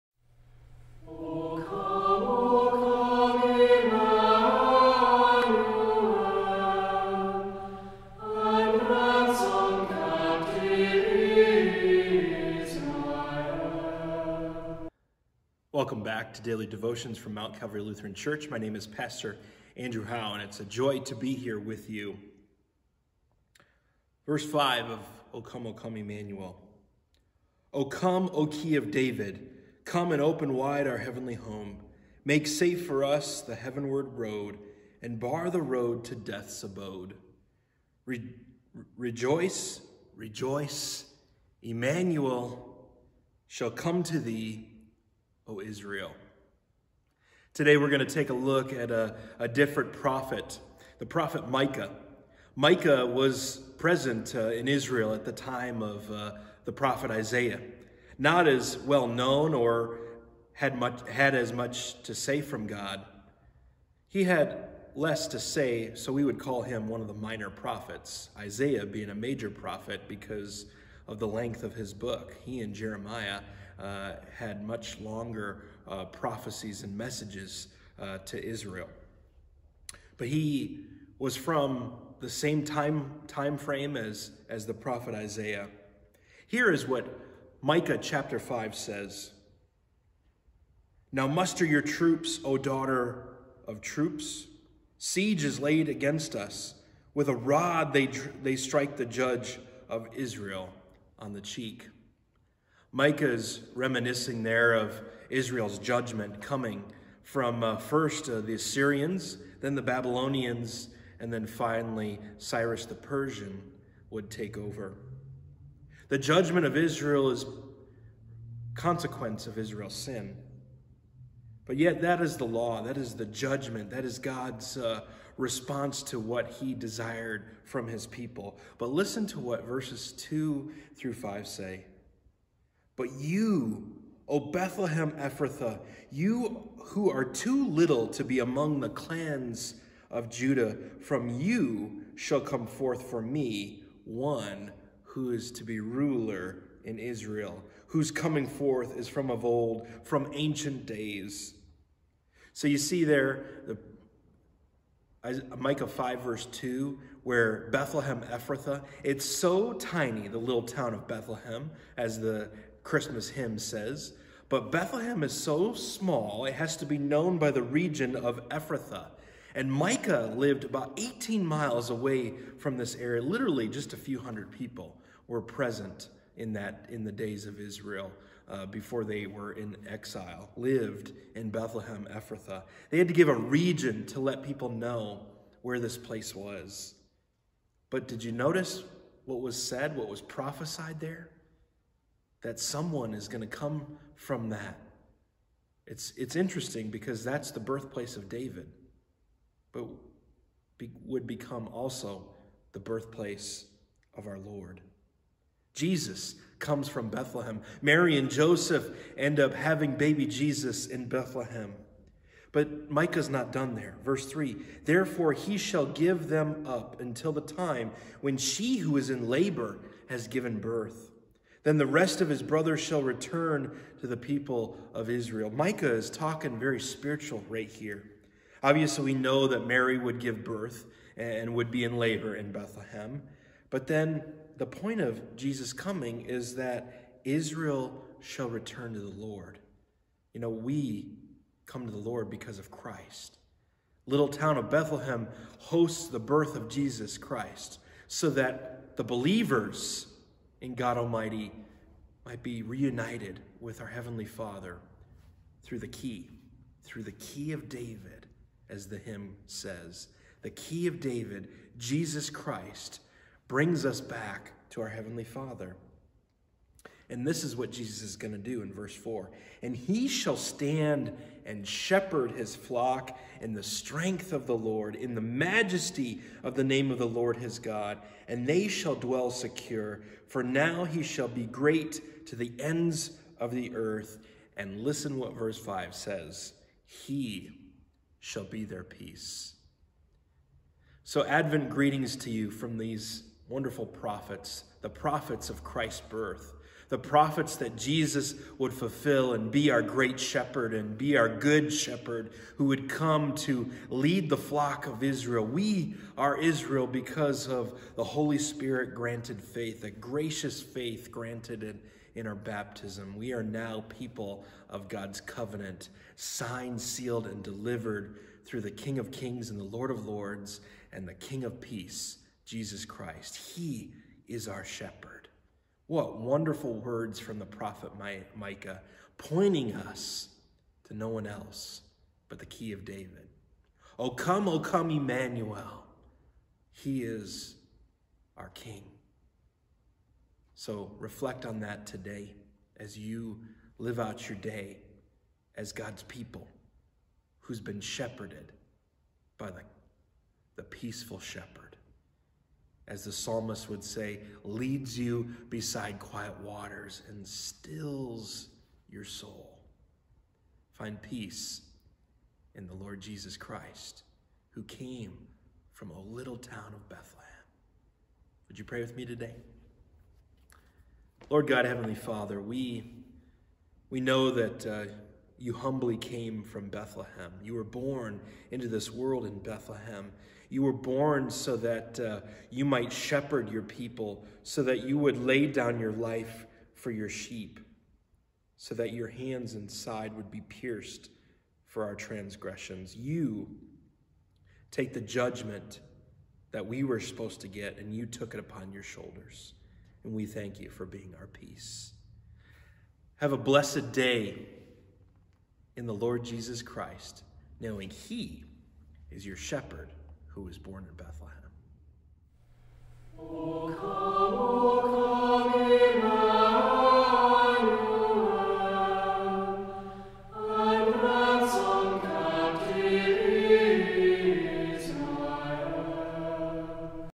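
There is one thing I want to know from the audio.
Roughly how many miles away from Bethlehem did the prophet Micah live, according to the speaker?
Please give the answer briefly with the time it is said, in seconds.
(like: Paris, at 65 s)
18, at 170 s.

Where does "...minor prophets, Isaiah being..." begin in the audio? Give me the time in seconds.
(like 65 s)
67 s.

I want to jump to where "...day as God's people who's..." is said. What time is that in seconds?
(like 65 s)
344 s.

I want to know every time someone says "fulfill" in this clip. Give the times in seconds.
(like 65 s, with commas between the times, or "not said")
298 s.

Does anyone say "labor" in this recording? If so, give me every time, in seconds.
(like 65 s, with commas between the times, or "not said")
219 s, 231 s.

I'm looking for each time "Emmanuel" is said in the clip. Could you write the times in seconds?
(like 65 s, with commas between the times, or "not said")
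25 s, 41 s, 334 s.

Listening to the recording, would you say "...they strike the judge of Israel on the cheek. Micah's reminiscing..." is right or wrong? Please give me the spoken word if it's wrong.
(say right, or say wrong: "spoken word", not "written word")
right.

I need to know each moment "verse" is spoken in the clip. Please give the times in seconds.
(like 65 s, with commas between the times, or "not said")
24 s, 129 s, 156 s, 214 s, 268 s, 285 s.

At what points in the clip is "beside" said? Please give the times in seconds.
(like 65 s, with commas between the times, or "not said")
355 s.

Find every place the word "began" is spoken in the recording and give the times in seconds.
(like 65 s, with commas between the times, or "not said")
not said.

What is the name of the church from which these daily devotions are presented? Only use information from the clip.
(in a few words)
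Mount Calvary Lutheran Church.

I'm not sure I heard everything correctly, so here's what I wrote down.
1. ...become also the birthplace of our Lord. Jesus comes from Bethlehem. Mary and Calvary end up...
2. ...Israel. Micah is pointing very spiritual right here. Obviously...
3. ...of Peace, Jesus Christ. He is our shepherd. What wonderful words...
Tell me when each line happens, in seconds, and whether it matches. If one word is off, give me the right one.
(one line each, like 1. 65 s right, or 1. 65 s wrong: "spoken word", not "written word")
1. 201 s wrong: "Joseph", not "Calvary"
2. 225 s wrong: "talking", not "pointing"
3. 321 s right.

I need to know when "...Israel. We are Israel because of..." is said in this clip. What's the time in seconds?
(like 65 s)
305 s.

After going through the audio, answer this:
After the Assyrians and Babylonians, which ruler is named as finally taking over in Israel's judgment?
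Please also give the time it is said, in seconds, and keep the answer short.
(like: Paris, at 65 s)
Cyrus the Persian, at 112 s.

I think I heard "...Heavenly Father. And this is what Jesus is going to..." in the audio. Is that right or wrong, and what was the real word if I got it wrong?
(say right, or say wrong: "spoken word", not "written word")
right.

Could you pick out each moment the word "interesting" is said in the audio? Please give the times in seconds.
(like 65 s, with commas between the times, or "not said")
196 s.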